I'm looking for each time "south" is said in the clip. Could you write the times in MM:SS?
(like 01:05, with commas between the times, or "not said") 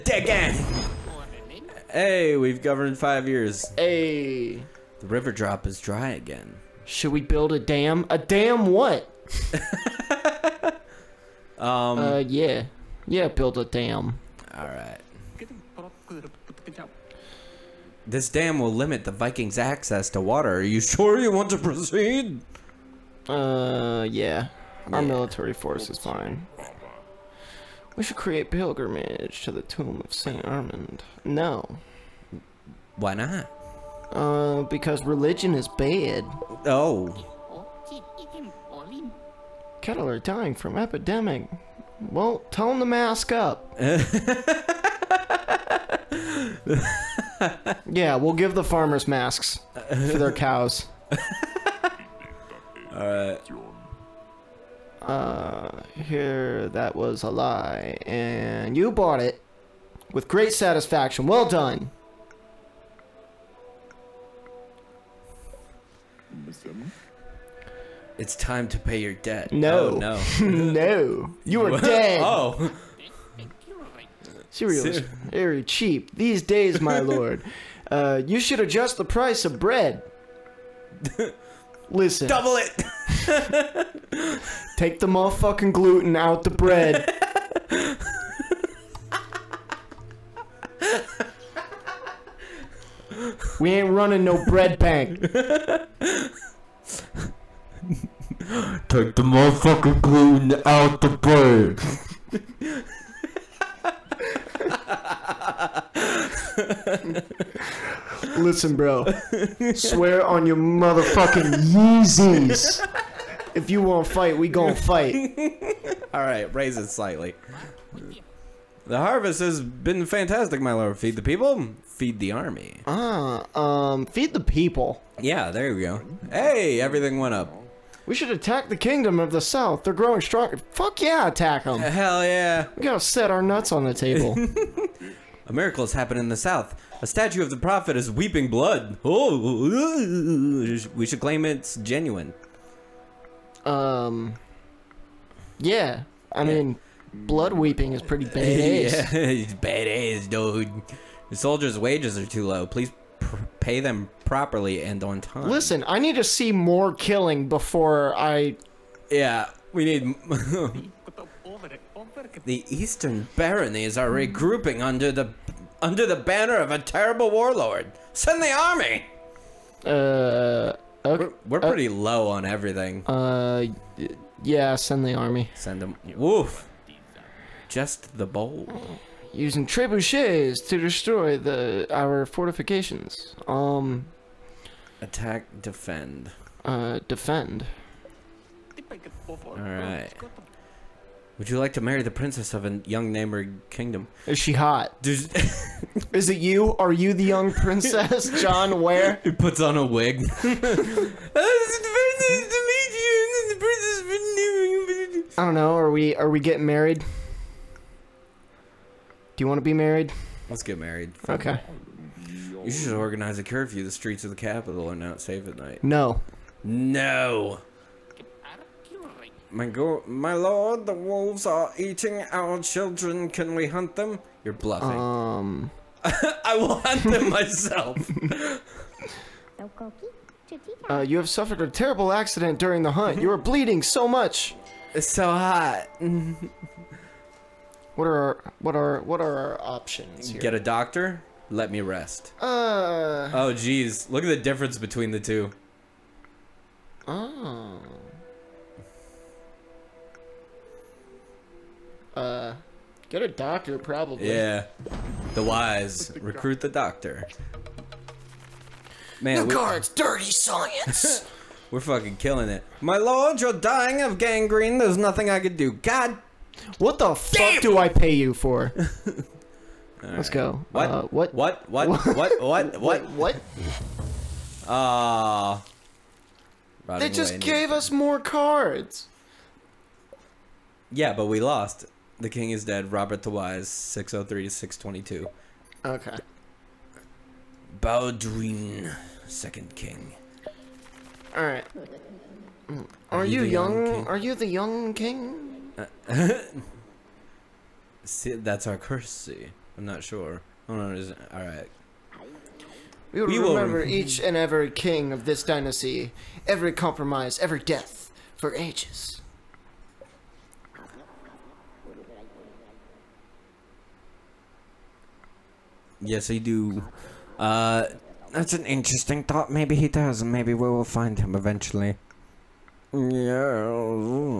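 02:09, 02:16.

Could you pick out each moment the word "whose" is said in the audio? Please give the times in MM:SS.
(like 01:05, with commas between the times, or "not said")
not said.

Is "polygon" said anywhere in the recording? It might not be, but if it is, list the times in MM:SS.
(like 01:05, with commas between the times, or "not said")
not said.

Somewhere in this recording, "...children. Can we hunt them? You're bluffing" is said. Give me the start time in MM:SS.
03:42.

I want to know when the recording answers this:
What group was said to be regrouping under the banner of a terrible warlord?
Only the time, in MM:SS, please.
02:42.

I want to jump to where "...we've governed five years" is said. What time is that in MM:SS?
00:02.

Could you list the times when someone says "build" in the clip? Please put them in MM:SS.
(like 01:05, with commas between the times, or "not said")
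00:07, 00:13.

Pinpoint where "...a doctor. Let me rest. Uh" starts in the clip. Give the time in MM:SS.
04:00.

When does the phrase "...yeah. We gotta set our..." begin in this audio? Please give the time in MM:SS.
02:12.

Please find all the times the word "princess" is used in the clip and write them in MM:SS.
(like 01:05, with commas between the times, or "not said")
03:12, 03:17.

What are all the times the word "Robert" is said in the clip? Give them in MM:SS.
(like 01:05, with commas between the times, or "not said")
04:42.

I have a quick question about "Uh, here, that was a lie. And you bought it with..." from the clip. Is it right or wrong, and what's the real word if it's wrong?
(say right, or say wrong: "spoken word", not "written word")
right.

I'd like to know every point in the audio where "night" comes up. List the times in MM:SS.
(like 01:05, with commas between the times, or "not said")
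03:35.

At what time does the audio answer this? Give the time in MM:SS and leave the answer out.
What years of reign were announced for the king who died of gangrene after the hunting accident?
04:43.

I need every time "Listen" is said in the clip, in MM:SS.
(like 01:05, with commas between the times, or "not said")
01:21, 01:48, 02:35.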